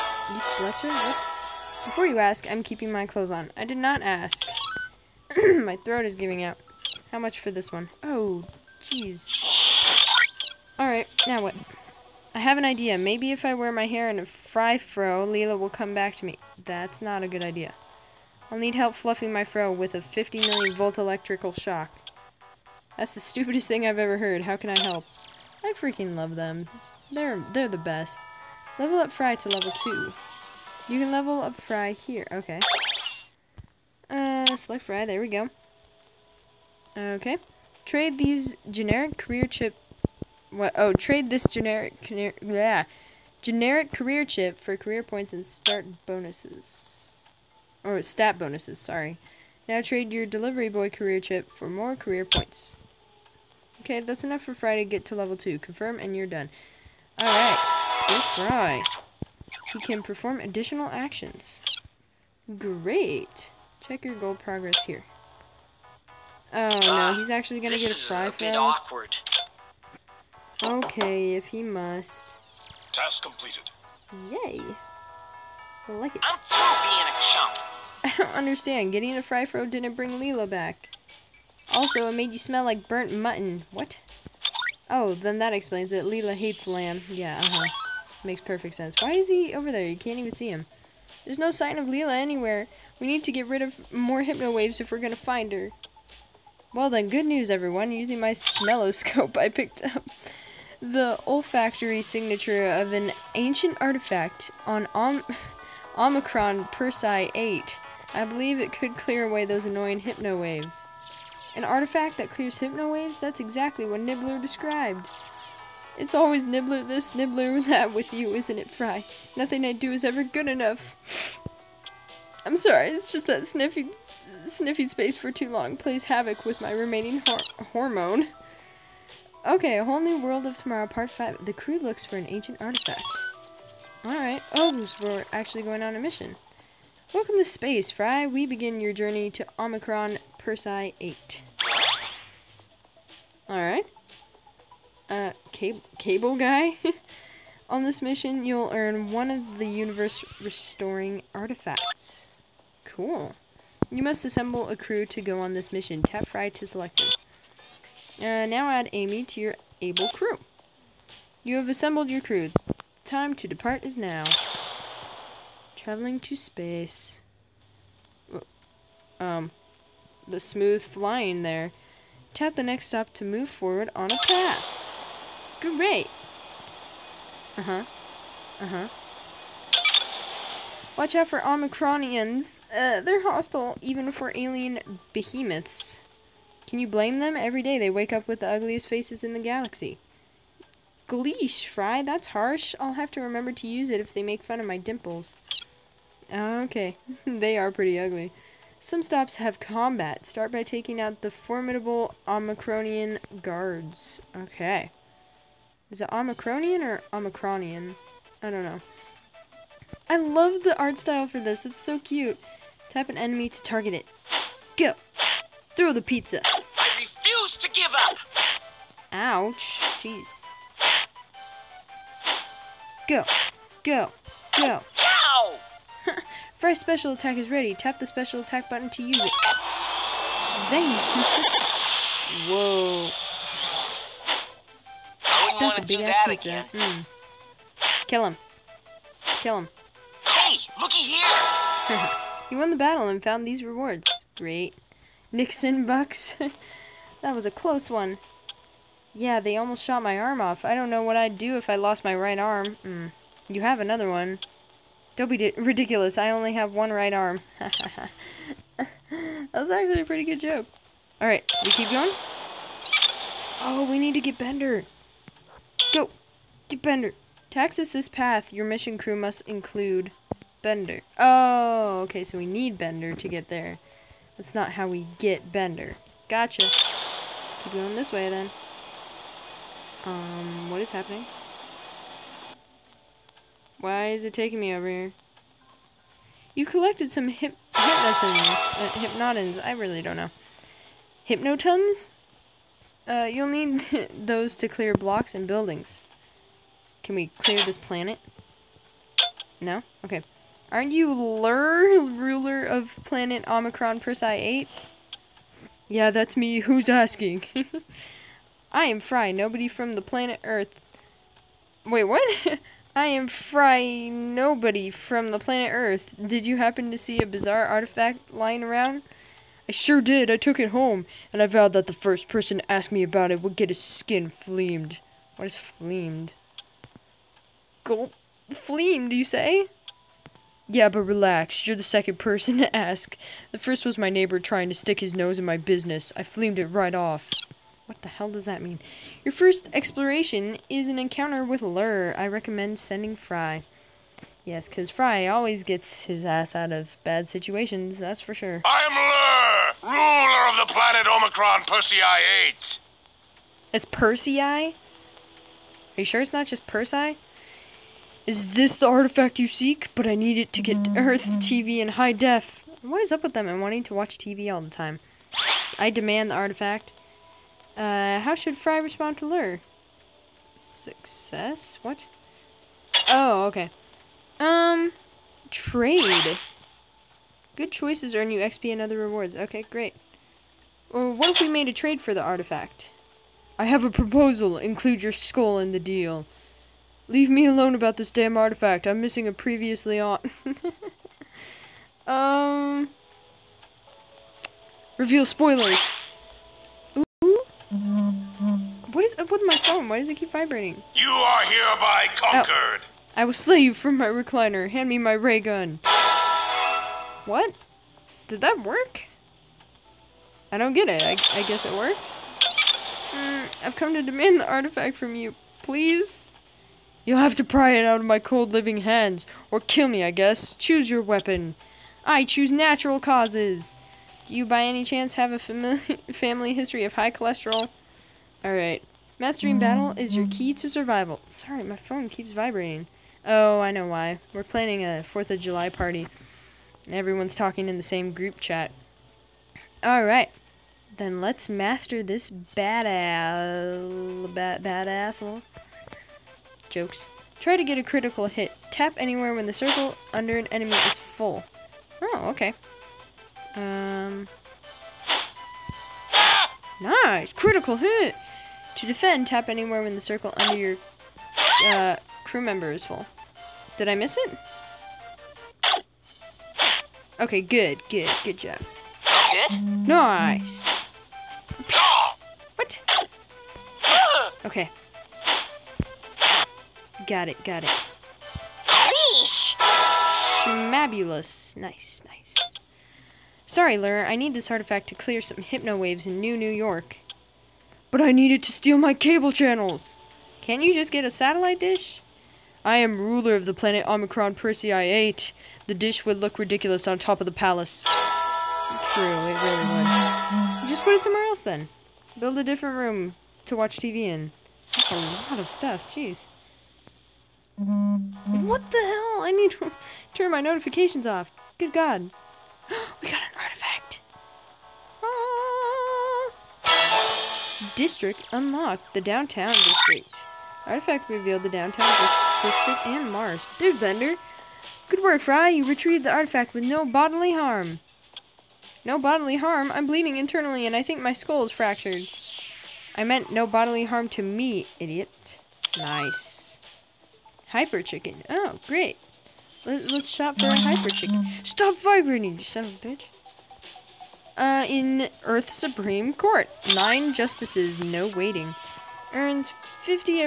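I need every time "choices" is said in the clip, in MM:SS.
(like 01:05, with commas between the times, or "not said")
06:17.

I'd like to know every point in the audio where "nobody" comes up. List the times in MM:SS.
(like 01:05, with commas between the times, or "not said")
05:09, 05:14.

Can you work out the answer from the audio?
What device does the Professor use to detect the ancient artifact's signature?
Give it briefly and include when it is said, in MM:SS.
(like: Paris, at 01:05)
smelloscope, at 01:38.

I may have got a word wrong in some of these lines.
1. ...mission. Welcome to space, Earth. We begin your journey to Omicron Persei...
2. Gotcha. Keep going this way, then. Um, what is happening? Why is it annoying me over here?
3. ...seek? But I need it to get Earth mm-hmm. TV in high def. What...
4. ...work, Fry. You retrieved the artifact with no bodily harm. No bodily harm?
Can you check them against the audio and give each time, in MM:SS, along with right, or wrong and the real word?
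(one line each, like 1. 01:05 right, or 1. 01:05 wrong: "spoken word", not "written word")
1. 02:16 wrong: "Fry", not "Earth"
2. 04:36 wrong: "taking", not "annoying"
3. 05:59 right
4. 08:45 right.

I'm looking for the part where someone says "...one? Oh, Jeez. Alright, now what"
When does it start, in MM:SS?
00:07.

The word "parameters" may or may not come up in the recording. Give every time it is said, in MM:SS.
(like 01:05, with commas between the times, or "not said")
not said.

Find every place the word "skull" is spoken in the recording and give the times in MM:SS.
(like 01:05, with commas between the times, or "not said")
06:25, 08:51.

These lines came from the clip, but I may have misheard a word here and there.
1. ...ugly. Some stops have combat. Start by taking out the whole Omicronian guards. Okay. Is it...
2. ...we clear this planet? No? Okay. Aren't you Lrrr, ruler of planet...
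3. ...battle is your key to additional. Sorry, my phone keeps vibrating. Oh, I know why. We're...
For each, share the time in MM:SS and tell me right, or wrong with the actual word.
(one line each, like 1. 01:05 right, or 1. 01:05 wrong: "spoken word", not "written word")
1. 03:17 wrong: "formidable", not "whole"
2. 04:57 right
3. 07:09 wrong: "survival", not "additional".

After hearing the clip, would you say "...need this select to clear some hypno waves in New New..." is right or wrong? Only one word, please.
wrong.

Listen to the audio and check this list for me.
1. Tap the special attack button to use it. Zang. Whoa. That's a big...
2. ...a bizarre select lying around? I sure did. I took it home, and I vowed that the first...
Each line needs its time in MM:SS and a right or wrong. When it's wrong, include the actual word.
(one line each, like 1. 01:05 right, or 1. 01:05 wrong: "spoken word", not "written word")
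1. 03:47 right
2. 05:17 wrong: "artifact", not "select".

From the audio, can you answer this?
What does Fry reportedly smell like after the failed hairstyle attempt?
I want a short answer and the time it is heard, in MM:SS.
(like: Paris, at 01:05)
burnt mutton, at 01:22.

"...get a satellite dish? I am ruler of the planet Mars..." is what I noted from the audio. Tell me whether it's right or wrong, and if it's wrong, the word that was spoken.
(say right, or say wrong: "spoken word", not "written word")
wrong: "Omicron", not "Mars".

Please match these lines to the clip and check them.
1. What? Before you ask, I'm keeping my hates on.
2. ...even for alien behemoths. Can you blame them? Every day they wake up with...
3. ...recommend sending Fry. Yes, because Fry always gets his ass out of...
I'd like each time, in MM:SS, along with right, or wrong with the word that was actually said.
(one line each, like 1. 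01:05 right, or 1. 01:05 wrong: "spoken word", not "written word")
1. 00:00 wrong: "clothes", not "hates"
2. 03:03 right
3. 05:42 right.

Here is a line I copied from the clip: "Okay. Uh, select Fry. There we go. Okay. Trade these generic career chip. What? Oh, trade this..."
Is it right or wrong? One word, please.
right.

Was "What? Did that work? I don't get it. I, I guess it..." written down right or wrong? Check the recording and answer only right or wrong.
right.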